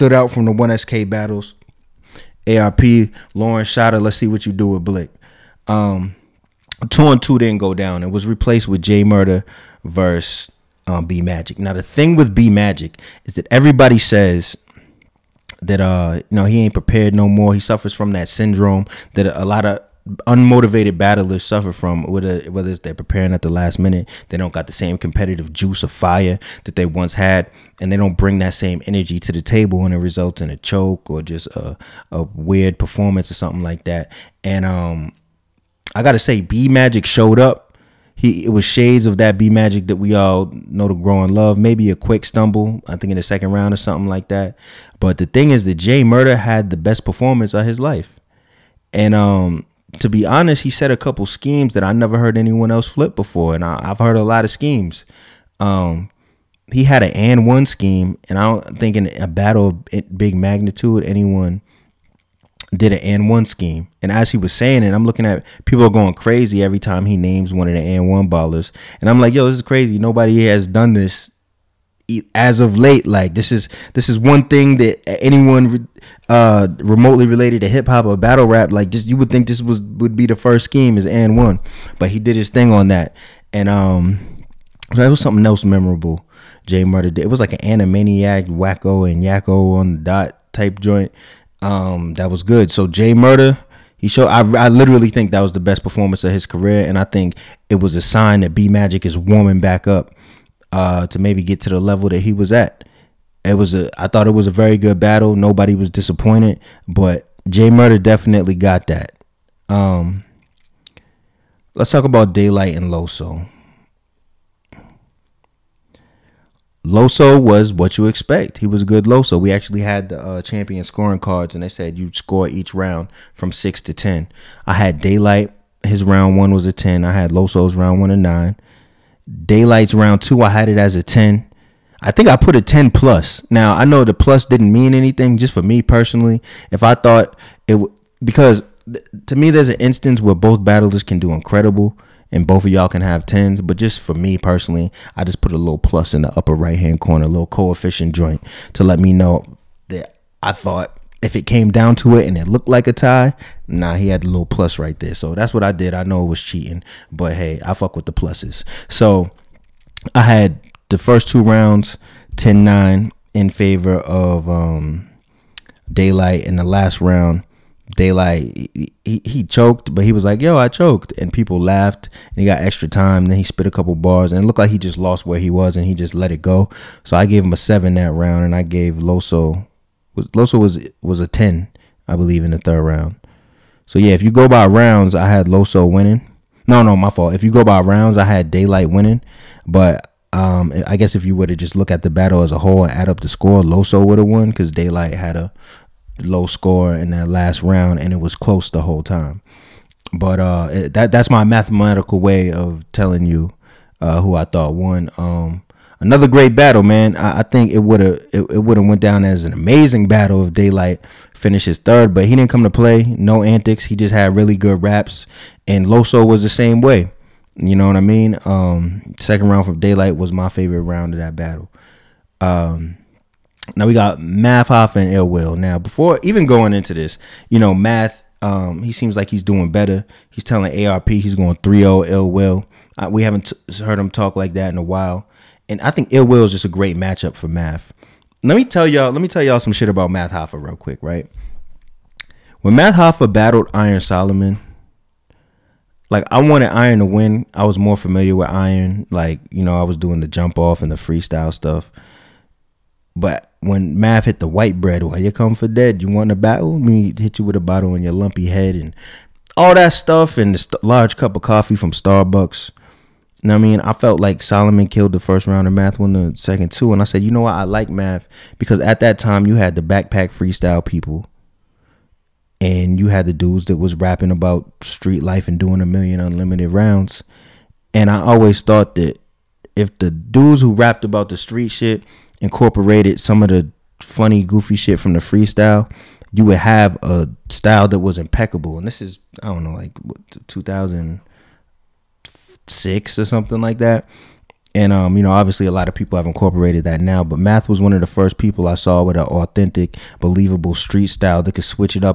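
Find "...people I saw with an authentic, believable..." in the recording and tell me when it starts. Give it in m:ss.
4:58.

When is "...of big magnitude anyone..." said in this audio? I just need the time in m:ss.
0:59.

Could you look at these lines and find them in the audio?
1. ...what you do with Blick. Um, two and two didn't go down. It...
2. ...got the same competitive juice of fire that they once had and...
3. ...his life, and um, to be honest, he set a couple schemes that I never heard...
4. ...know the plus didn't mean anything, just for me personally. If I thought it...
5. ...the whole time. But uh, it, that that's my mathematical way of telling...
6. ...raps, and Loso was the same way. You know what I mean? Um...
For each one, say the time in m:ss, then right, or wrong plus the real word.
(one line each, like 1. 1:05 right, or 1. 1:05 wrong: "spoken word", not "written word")
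1. 0:04 right
2. 0:24 right
3. 0:47 right
4. 2:13 right
5. 3:18 right
6. 3:34 right.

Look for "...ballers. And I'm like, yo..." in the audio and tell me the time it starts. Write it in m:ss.
1:08.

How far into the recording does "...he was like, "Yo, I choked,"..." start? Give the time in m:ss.
2:50.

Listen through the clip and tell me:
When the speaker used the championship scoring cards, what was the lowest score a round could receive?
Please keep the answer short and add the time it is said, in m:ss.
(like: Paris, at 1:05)
6, at 2:03.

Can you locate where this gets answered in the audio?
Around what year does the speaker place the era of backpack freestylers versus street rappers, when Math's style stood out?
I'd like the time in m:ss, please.
4:50.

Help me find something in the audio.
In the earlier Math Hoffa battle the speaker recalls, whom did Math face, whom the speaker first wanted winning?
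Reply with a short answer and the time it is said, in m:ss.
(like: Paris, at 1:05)
Iron Solomon, at 4:03.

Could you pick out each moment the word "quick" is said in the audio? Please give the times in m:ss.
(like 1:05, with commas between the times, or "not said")
0:41, 4:00.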